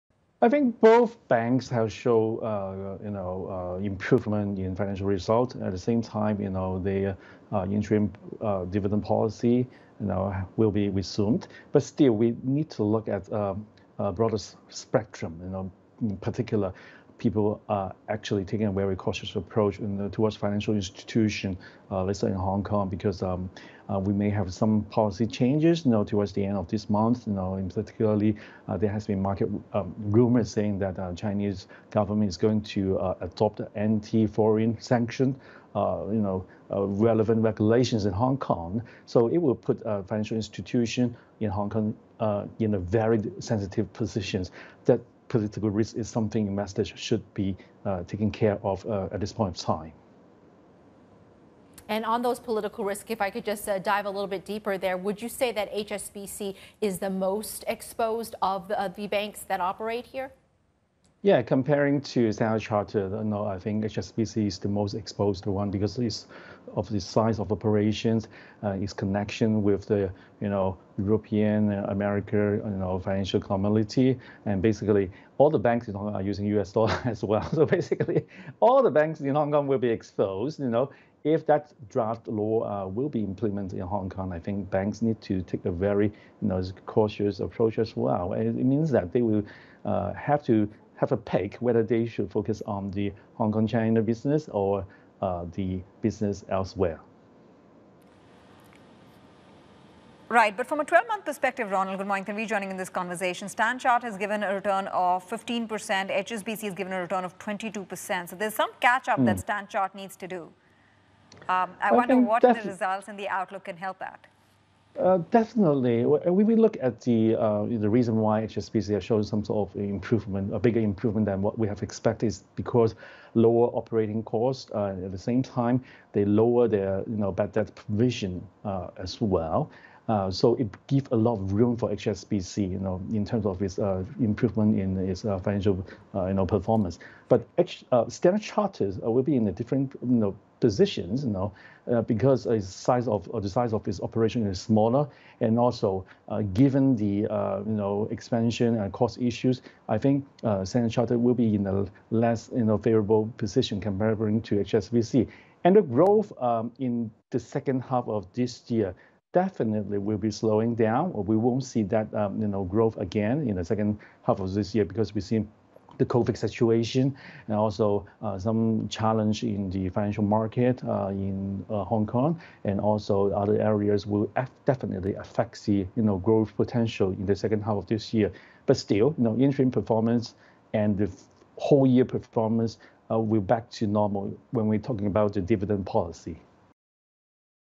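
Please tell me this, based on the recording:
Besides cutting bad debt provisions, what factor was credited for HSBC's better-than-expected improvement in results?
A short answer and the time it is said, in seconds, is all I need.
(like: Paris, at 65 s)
Lower operating costs, at 123 s.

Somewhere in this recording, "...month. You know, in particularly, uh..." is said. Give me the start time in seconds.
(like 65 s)
26 s.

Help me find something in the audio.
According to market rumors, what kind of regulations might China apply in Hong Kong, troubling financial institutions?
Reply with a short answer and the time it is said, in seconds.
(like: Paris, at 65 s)
Anti-foreign sanction, at 33 s.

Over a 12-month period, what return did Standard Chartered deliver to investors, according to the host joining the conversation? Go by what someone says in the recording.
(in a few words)
15%.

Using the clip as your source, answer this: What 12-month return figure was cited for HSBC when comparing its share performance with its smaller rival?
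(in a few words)
22%.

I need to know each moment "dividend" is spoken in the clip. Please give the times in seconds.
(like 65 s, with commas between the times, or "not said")
8 s, 185 s.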